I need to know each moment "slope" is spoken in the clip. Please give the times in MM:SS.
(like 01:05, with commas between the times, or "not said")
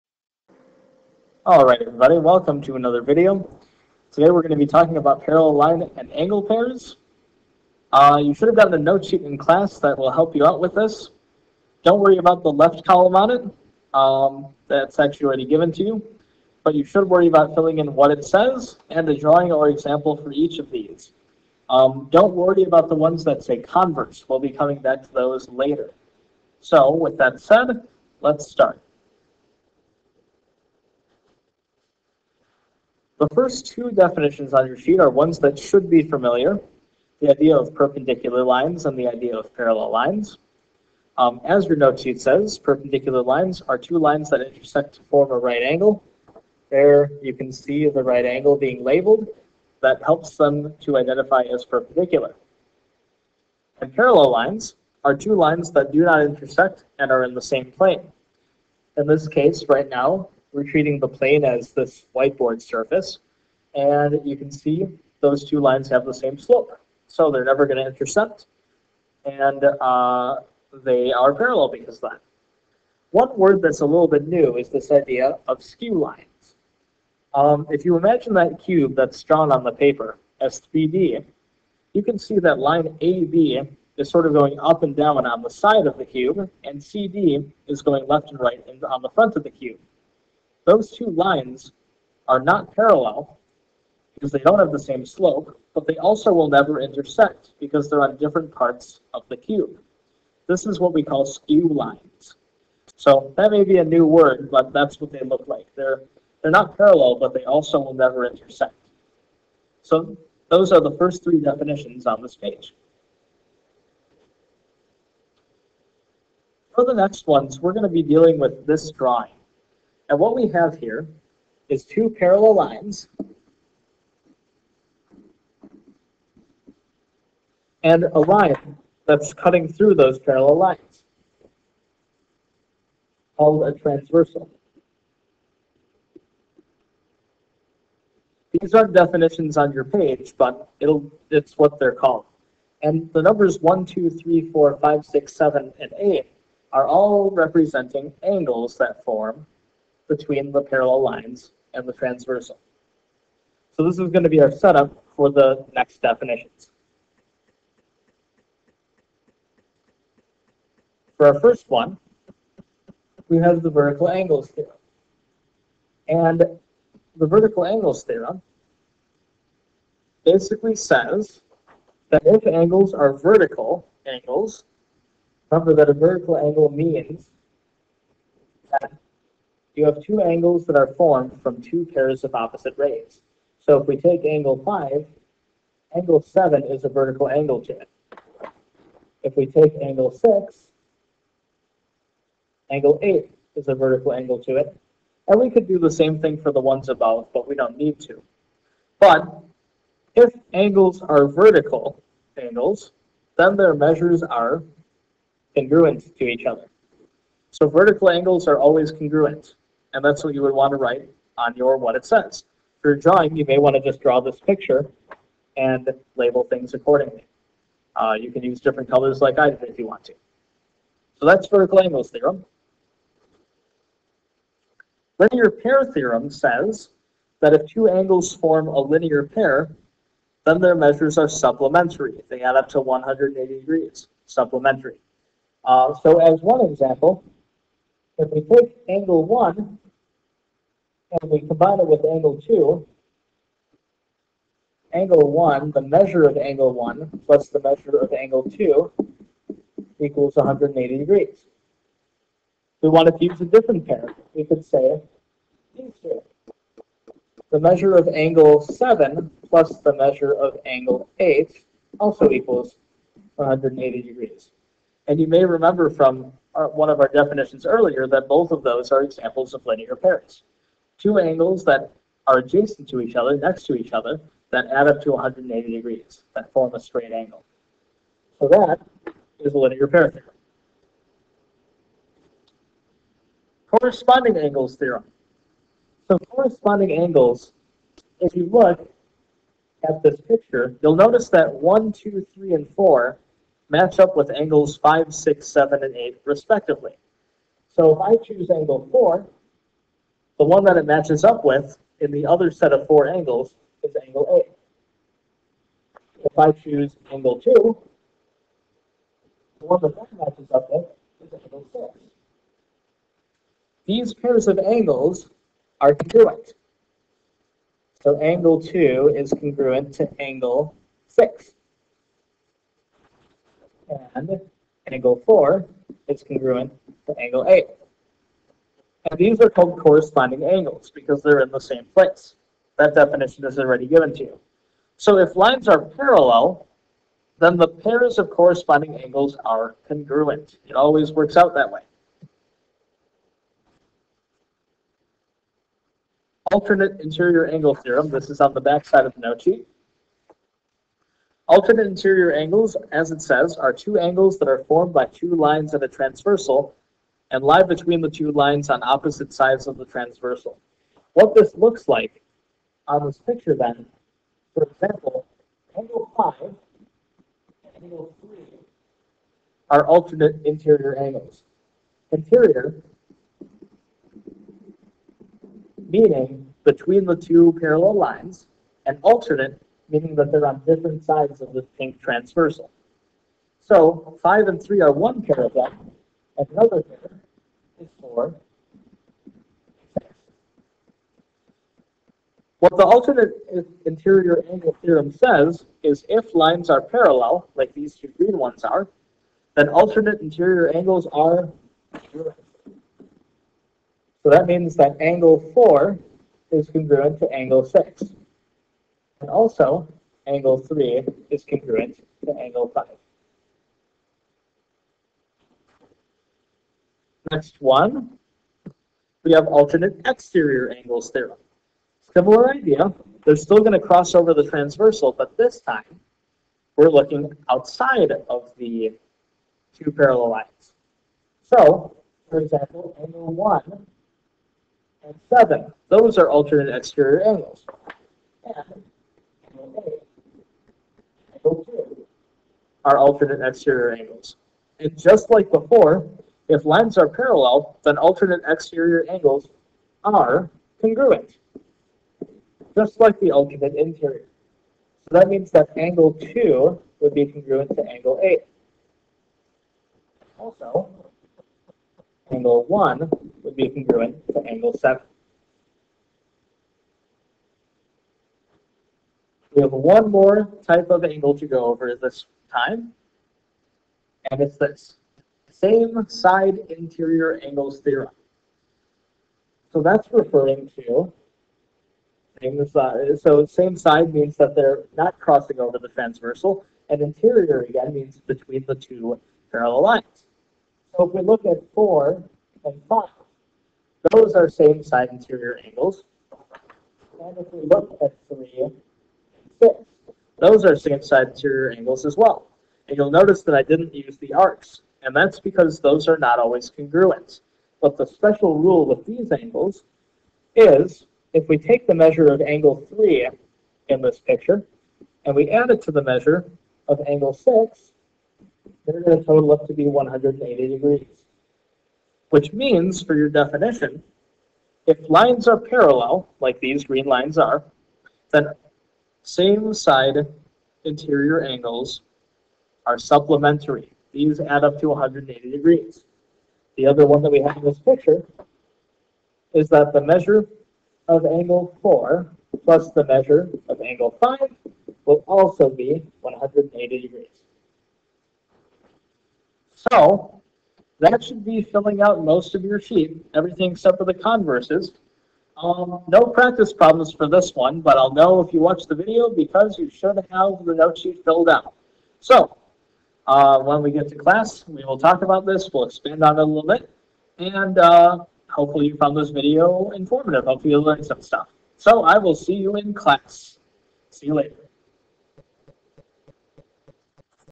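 01:06, 01:35.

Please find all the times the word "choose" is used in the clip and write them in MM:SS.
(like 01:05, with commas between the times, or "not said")
04:58, 05:06.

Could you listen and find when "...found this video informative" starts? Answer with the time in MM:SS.
09:28.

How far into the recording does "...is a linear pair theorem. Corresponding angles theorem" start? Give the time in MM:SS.
04:39.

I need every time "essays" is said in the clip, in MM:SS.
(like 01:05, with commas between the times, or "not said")
not said.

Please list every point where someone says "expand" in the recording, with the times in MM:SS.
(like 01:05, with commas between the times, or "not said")
09:25.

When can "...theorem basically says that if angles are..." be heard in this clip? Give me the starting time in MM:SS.
02:48.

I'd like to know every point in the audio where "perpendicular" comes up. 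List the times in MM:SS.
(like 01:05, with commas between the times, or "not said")
00:37, 00:42, 00:51.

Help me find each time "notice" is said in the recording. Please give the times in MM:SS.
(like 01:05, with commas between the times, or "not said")
04:50, 08:23.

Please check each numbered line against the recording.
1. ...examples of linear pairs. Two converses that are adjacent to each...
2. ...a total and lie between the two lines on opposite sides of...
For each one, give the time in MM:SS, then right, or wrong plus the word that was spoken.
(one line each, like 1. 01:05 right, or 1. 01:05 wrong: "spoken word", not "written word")
1. 04:29 wrong: "angles", not "converses"
2. 05:55 wrong: "transversal", not "total".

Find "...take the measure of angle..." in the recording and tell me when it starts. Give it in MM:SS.
08:31.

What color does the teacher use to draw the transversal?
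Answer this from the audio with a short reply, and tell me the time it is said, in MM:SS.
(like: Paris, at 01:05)
Pink, at 06:21.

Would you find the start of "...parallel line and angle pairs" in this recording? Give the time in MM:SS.
00:05.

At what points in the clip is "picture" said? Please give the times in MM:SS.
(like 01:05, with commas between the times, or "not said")
03:34, 04:50, 06:03, 08:34, 08:57.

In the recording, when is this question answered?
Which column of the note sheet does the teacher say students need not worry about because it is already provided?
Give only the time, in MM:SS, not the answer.
00:12.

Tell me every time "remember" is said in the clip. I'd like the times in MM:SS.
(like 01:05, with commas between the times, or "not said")
02:55, 04:25.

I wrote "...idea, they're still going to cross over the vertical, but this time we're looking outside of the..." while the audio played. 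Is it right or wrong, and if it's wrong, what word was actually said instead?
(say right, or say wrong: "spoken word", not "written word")
wrong: "transversal", not "vertical".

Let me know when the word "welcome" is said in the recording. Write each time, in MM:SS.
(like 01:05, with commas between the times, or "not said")
00:02.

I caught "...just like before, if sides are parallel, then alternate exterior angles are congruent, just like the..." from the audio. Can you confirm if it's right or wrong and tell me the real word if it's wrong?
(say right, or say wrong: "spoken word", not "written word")
wrong: "lines", not "sides".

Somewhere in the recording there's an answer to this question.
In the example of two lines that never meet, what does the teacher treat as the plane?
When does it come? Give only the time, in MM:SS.
01:01.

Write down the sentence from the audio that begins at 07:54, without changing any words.
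And it's this same side interior angles theorem.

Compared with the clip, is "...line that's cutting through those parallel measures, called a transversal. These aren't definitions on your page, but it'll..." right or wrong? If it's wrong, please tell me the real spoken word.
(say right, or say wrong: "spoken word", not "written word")
wrong: "lines", not "measures".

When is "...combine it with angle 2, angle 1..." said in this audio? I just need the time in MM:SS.
04:01.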